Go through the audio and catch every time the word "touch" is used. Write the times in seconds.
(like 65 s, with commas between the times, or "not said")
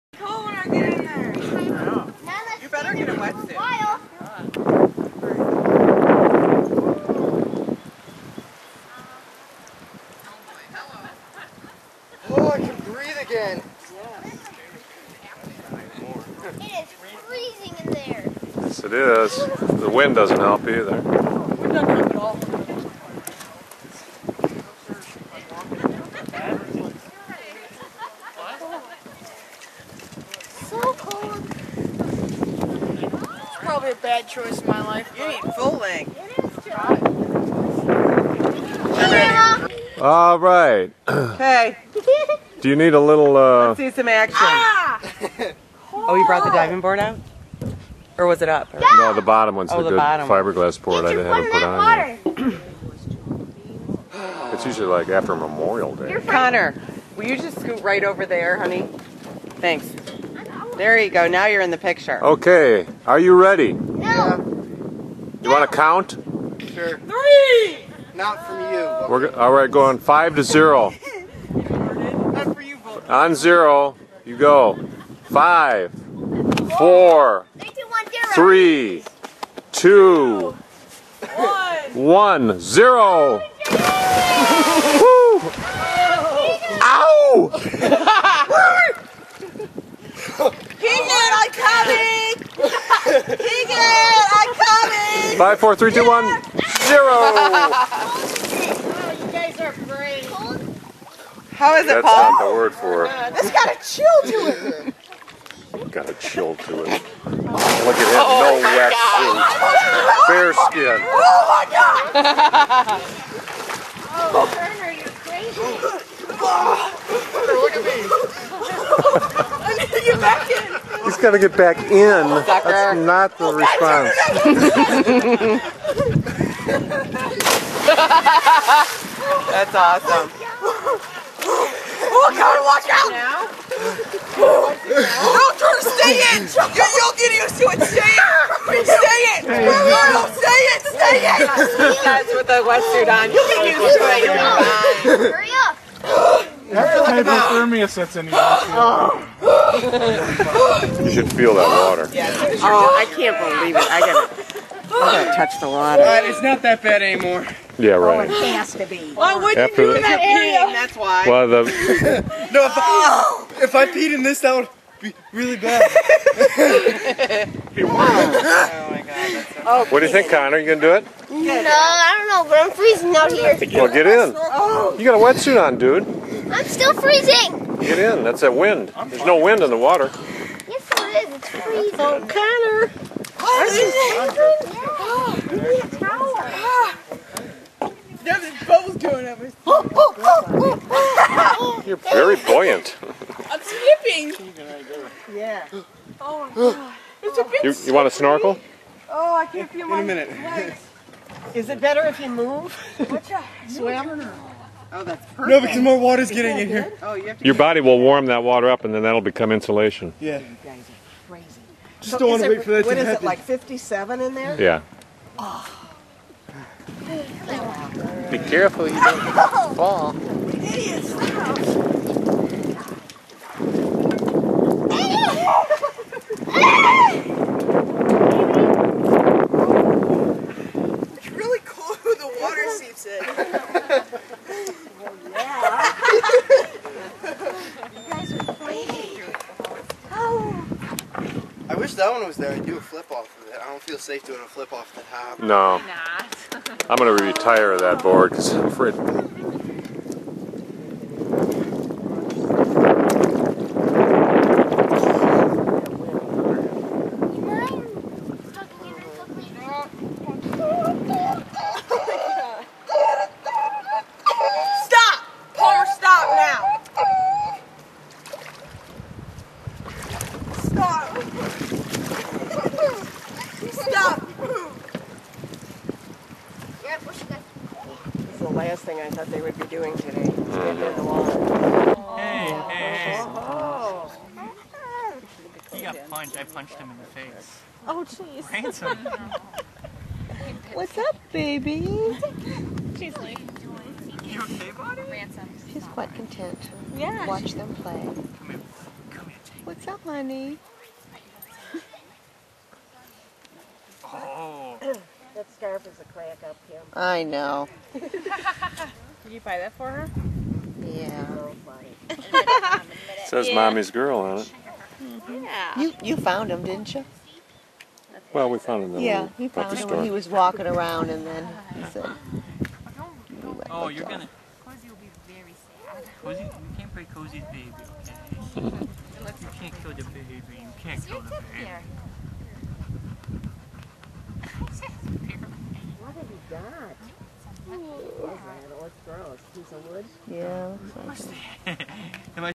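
155 s.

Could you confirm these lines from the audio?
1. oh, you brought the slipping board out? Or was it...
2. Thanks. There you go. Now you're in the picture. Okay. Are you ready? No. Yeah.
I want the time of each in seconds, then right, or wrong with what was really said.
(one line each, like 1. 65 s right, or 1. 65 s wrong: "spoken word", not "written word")
1. 45 s wrong: "diving", not "slipping"
2. 59 s right.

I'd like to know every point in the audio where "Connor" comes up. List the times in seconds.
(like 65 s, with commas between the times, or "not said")
56 s, 170 s, 182 s.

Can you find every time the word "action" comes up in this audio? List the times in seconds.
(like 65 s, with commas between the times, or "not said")
44 s.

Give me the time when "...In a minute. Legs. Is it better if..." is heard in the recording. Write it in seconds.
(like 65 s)
200 s.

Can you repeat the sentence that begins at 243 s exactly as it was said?
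I don't feel safe doing a flip off the top.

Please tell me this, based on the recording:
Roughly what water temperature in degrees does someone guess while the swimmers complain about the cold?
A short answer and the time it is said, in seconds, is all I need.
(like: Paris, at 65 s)
57, at 213 s.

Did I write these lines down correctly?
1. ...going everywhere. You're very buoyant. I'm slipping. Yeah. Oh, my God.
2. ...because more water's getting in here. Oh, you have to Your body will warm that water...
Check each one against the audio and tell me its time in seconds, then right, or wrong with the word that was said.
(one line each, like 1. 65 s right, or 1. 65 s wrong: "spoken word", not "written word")
1. 188 s right
2. 205 s right.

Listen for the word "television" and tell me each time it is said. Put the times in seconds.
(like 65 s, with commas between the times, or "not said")
not said.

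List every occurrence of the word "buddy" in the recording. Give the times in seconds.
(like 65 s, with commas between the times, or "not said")
294 s.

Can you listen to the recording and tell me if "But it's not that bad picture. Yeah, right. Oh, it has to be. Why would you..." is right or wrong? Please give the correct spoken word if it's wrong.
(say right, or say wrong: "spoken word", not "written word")
wrong: "anymore", not "picture".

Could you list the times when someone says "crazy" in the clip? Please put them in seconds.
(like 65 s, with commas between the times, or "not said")
115 s, 211 s.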